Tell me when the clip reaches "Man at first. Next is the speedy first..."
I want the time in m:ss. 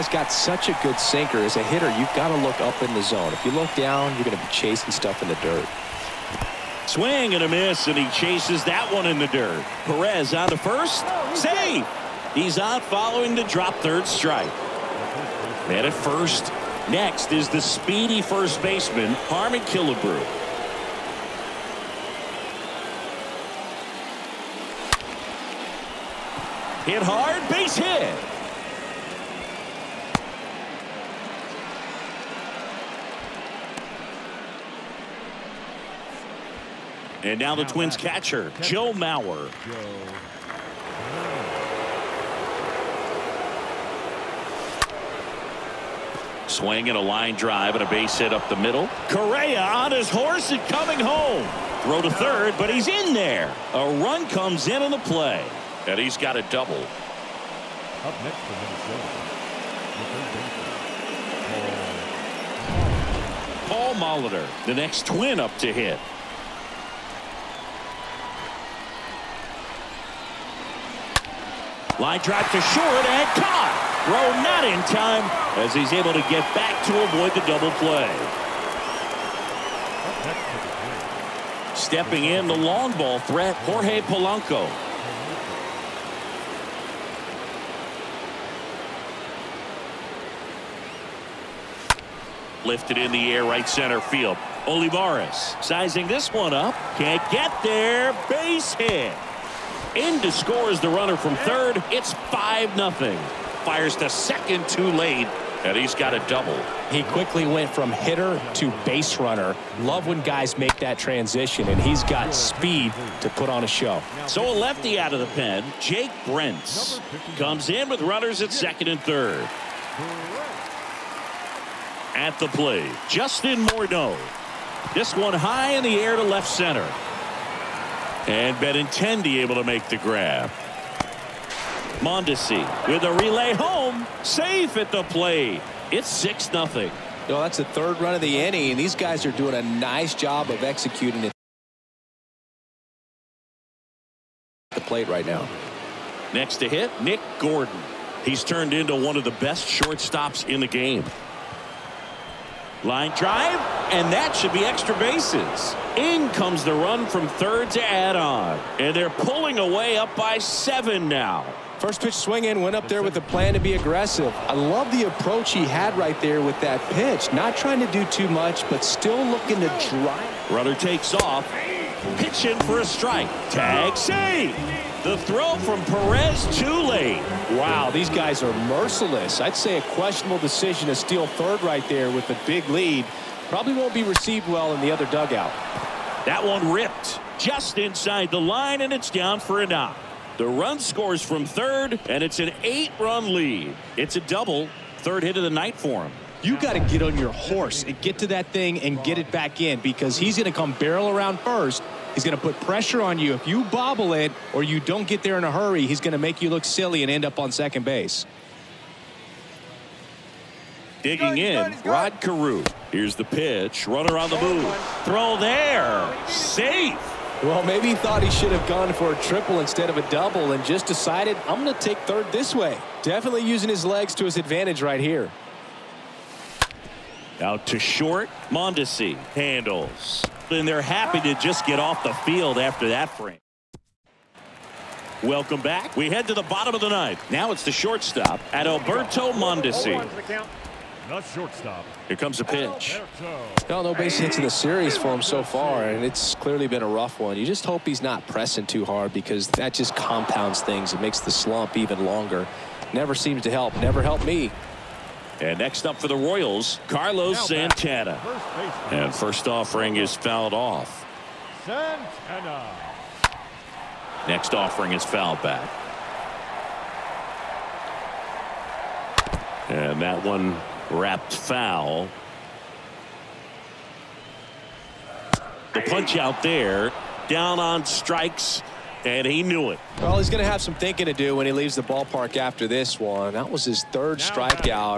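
0:15.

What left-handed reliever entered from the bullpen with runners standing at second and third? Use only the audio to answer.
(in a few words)
Jake Brentz.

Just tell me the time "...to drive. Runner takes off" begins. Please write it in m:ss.
2:49.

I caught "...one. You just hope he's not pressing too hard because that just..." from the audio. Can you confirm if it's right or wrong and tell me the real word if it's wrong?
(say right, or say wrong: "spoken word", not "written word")
right.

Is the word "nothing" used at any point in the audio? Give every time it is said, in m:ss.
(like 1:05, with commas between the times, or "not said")
1:42, 2:16.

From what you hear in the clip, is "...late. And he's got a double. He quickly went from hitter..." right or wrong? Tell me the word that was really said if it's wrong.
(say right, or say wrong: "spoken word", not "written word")
right.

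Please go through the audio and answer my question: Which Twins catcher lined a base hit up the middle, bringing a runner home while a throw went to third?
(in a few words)
Joe Mauer.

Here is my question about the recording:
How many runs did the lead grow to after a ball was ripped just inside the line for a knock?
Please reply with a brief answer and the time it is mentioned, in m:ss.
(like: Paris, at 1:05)
8, at 3:12.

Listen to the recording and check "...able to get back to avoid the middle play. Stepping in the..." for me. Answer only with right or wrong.
wrong.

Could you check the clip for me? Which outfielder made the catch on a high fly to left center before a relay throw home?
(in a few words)
Benintendi.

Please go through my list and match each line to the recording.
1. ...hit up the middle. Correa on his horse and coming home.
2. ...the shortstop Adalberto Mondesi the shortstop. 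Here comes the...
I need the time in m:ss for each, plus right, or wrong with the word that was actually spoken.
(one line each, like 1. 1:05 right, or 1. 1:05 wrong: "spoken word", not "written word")
1. 0:48 right
2. 3:57 right.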